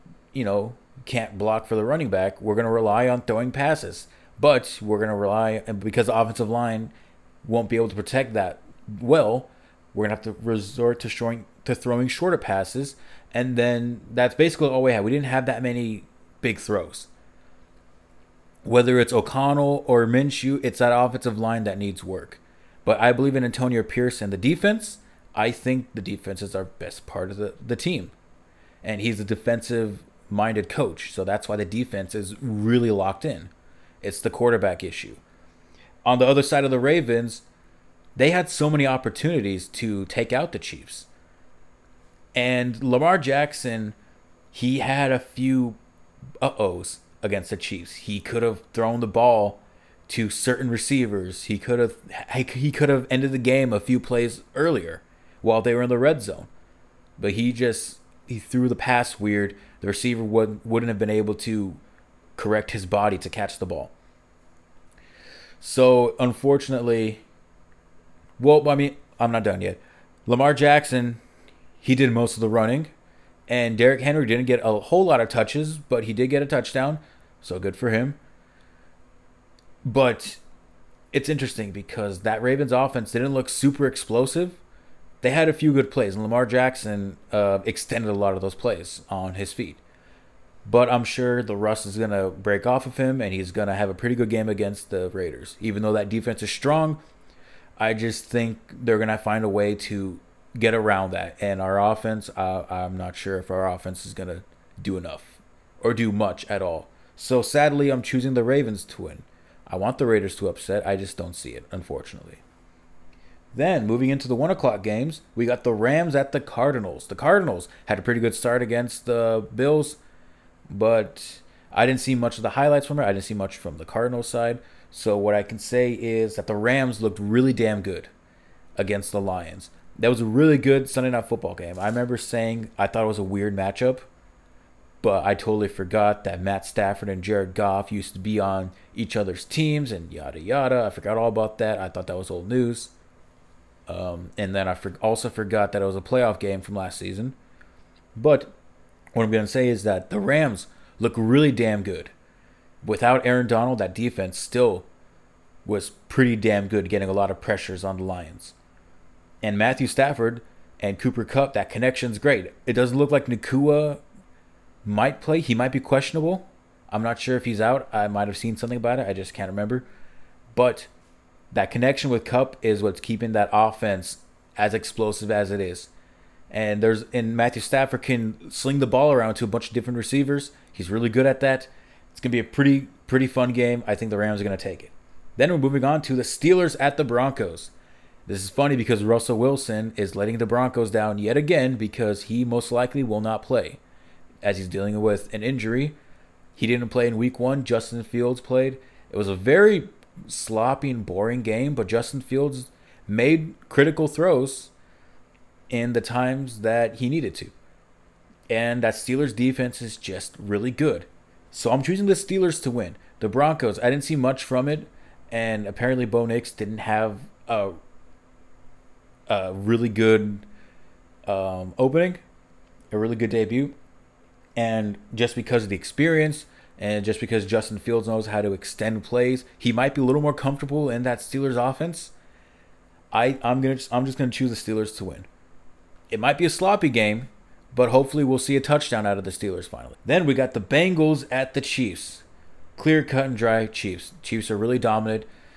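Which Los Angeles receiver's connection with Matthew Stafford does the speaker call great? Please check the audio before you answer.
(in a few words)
Cooper Kupp.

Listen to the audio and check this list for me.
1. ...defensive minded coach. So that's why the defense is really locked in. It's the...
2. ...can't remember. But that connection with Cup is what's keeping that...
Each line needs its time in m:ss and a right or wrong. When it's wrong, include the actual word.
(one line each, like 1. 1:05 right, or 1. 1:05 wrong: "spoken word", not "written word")
1. 0:29 right
2. 2:49 right.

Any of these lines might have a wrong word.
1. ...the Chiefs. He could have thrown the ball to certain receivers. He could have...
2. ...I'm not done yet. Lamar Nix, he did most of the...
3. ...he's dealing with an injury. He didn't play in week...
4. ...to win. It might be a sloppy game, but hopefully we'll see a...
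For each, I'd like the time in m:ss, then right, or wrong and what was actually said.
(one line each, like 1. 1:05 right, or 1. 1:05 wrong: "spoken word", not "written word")
1. 0:47 right
2. 1:09 wrong: "Jackson", not "Nix"
3. 3:14 right
4. 3:54 right.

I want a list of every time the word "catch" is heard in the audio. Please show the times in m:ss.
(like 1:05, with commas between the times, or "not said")
1:03.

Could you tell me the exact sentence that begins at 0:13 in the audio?
And then that's basically all we had.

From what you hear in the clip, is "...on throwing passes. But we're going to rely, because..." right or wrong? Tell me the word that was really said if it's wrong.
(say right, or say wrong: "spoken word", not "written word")
right.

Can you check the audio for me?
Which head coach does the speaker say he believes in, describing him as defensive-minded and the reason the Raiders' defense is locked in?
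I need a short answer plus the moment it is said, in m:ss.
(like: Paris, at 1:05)
Antonio Pierce, at 0:23.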